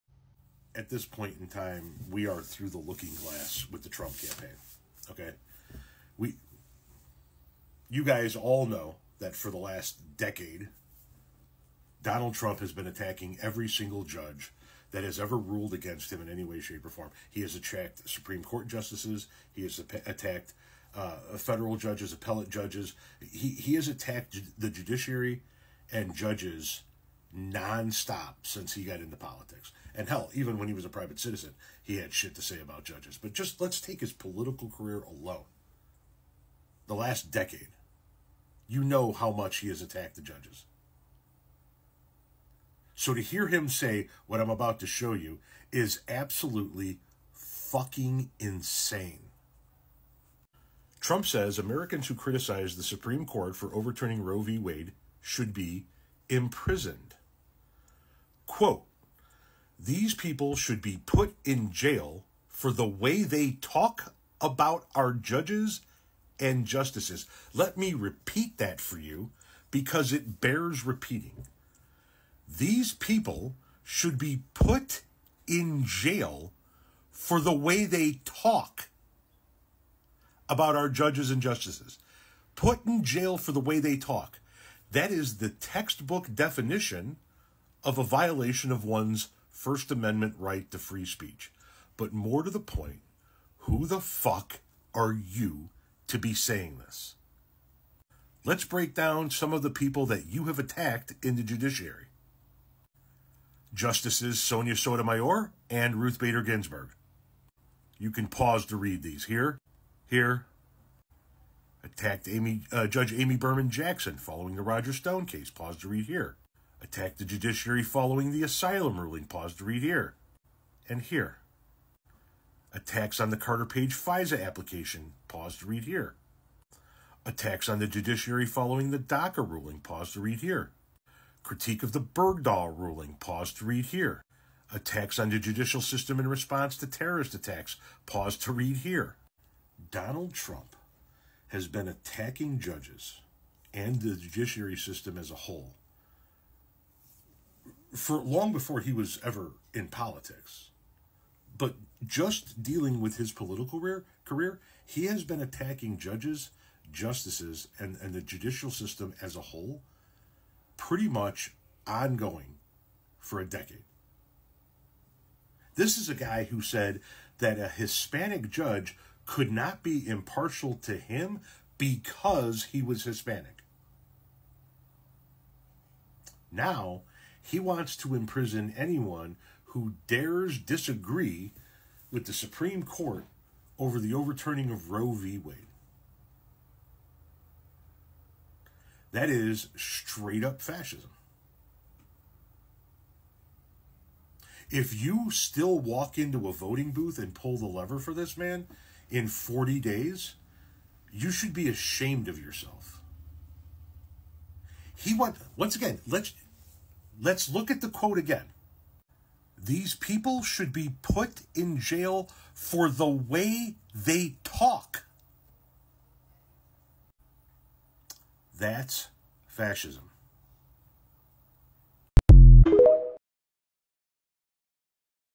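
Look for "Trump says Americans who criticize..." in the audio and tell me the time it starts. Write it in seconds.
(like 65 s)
50 s.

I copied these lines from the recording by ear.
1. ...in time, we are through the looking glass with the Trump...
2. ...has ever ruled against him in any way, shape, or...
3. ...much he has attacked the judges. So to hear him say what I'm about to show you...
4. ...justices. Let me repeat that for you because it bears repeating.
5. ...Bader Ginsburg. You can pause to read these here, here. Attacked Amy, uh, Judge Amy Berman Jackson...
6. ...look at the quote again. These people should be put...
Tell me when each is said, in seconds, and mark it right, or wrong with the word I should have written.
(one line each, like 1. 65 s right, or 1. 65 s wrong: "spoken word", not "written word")
1. 1 s right
2. 15 s right
3. 39 s right
4. 66 s right
5. 106 s right
6. 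207 s right.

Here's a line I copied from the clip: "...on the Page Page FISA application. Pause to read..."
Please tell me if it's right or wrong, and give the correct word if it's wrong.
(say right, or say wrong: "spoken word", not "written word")
wrong: "Carter", not "Page".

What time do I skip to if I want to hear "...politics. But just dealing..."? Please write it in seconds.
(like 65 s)
149 s.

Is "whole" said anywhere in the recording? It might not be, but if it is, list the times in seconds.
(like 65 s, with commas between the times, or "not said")
145 s, 159 s.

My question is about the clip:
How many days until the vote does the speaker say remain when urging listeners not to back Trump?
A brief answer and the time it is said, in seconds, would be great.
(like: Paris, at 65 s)
40, at 199 s.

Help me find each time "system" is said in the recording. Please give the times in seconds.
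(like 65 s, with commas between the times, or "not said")
135 s, 144 s, 158 s.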